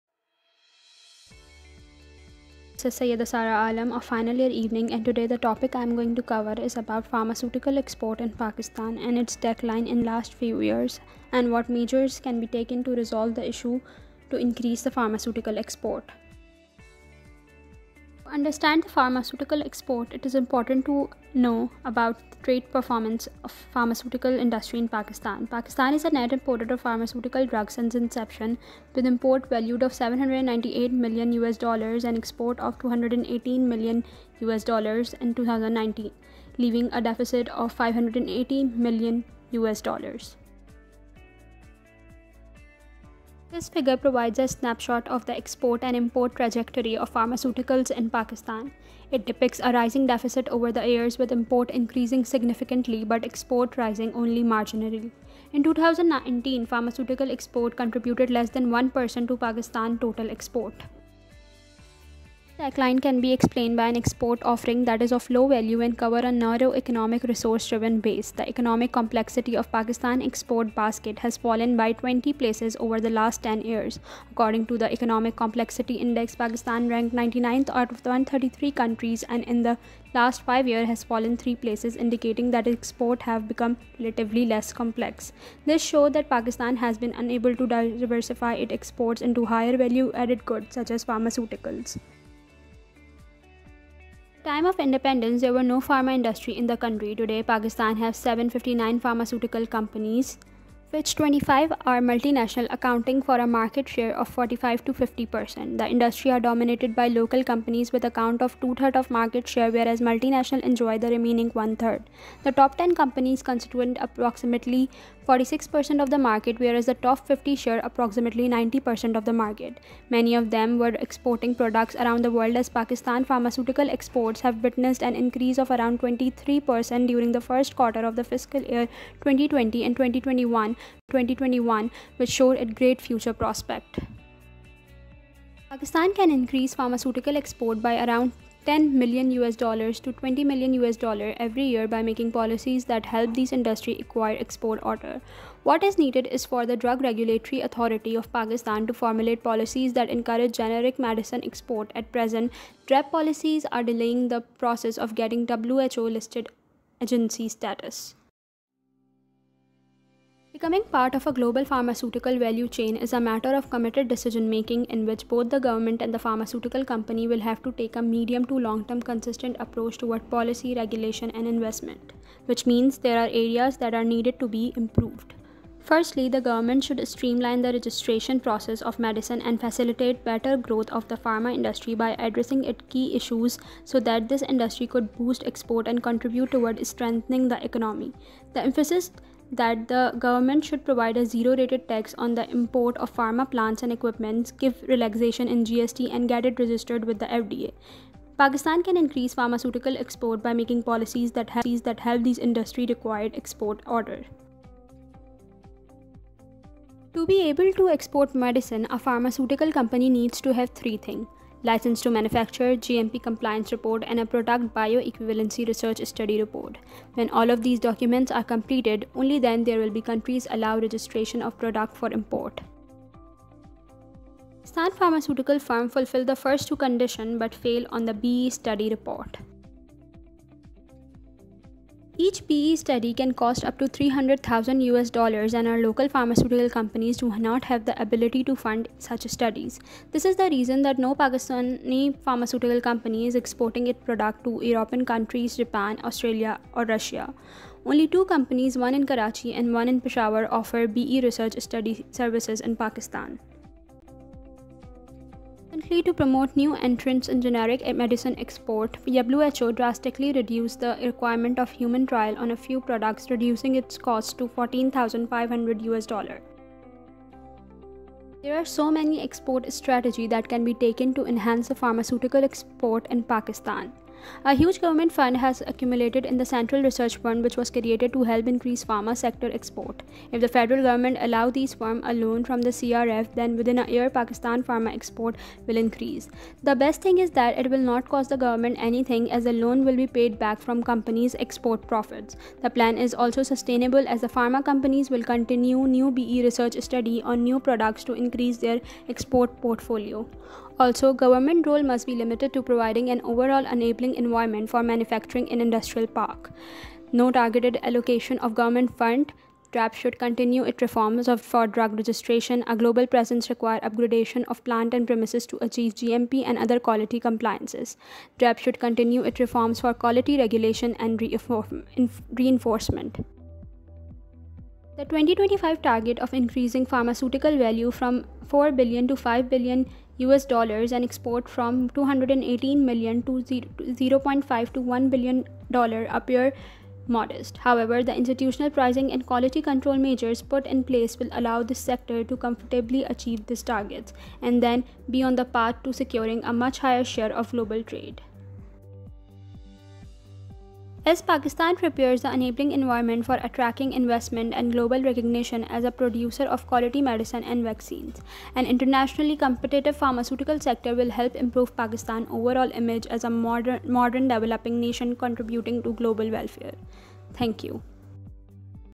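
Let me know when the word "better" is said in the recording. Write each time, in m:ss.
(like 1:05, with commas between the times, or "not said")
3:00.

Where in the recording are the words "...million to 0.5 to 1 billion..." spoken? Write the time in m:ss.
5:32.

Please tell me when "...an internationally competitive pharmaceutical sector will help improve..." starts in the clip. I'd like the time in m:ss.
5:58.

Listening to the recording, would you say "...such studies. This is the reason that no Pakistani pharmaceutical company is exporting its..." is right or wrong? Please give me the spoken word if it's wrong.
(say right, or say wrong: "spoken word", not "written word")
right.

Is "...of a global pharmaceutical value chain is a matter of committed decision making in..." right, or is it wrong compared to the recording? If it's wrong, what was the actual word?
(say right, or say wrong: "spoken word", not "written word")
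right.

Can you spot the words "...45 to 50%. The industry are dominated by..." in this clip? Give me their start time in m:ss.
1:44.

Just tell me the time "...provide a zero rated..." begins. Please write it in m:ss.
3:10.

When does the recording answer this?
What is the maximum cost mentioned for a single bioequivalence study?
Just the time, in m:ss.
3:53.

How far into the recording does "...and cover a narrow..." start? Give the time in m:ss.
1:05.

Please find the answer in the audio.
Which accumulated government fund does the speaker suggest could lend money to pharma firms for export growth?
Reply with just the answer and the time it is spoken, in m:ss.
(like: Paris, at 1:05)
Central Research Fund, at 4:36.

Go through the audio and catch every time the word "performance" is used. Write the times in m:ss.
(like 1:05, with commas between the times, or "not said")
0:22.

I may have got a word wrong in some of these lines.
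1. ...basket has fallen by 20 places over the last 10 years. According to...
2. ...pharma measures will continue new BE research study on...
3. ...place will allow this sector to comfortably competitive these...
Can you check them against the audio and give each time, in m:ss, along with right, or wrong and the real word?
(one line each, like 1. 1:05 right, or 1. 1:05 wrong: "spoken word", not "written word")
1. 1:10 right
2. 4:54 wrong: "companies", not "measures"
3. 5:40 wrong: "achieve", not "competitive".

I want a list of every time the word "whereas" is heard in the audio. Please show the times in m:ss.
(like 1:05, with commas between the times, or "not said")
1:49, 1:56.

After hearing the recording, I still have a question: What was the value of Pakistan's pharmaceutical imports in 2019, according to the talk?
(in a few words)
$798 million.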